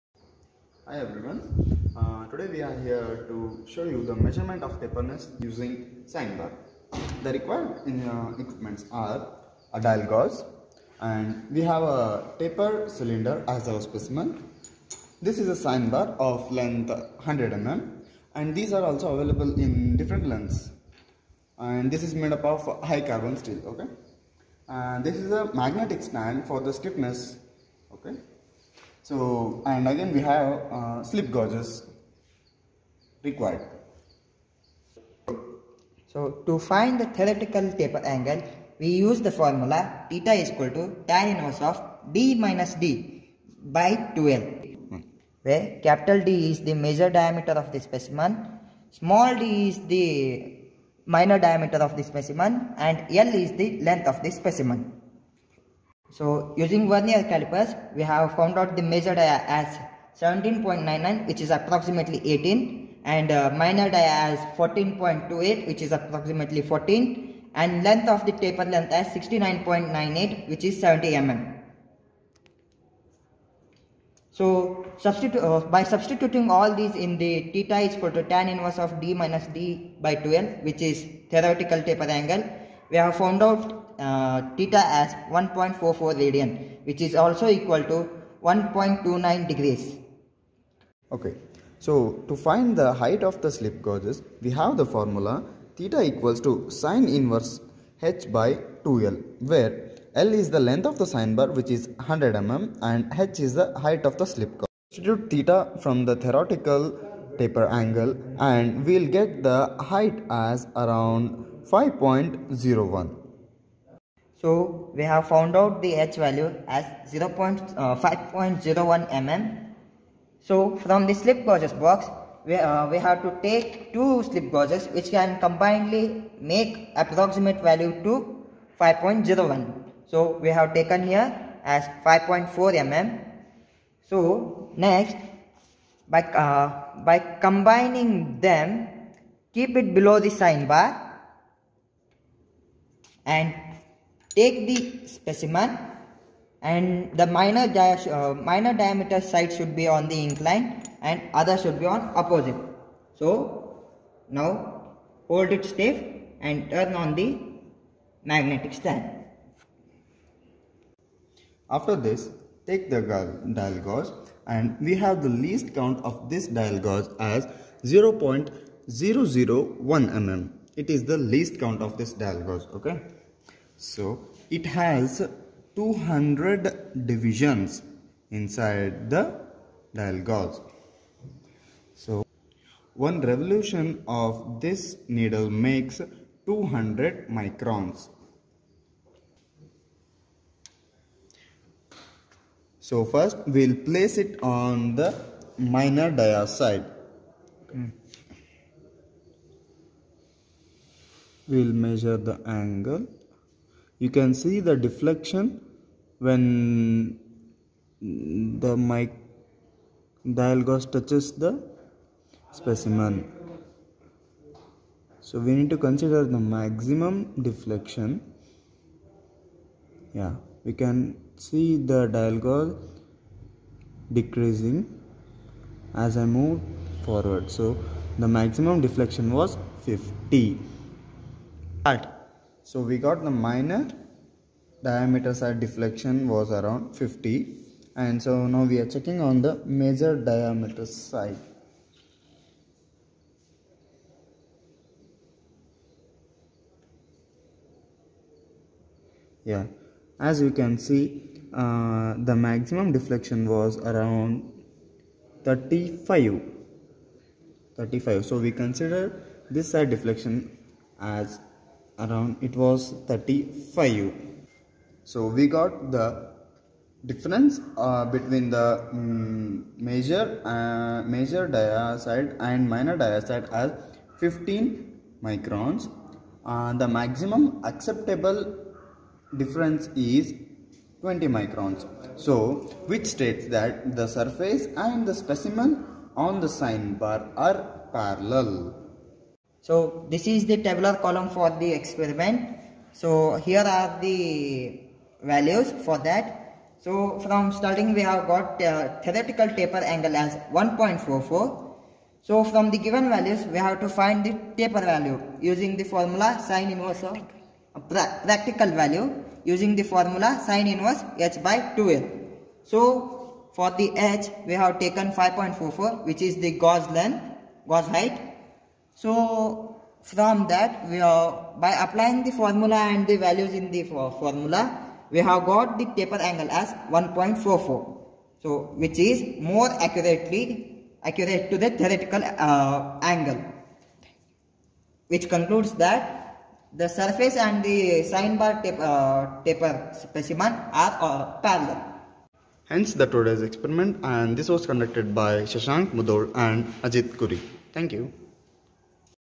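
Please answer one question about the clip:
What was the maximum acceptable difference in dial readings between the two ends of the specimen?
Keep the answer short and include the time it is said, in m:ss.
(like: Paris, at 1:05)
20 microns, at 4:41.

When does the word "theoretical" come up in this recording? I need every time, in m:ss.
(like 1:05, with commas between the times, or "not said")
0:37, 1:21, 1:46, 4:59, 5:31.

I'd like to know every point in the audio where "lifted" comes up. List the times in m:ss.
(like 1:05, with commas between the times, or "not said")
not said.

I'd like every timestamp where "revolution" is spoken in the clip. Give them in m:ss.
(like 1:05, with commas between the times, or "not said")
3:03.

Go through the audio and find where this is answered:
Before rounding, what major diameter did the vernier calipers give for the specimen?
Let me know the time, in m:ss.
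1:00.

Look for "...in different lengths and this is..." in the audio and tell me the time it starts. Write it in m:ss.
0:19.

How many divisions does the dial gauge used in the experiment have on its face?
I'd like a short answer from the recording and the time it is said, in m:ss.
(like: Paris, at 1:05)
200, at 2:55.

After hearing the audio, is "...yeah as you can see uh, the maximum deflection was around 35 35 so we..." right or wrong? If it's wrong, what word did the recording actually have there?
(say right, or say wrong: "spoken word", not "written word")
right.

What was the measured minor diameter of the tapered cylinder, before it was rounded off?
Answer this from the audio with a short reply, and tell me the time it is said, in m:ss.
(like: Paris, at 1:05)
14.28, at 1:04.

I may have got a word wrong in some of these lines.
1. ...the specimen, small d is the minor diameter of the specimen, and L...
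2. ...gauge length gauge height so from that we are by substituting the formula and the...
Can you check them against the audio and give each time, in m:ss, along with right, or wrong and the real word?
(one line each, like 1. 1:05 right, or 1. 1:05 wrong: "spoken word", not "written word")
1. 0:47 right
2. 5:16 wrong: "applying", not "substituting".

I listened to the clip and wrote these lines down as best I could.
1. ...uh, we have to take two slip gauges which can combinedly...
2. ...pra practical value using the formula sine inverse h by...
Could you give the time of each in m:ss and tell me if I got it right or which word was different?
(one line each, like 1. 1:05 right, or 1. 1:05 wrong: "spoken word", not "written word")
1. 2:02 right
2. 5:07 right.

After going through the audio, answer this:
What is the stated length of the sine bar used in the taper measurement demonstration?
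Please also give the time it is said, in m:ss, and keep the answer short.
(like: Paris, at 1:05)
100 mm, at 0:16.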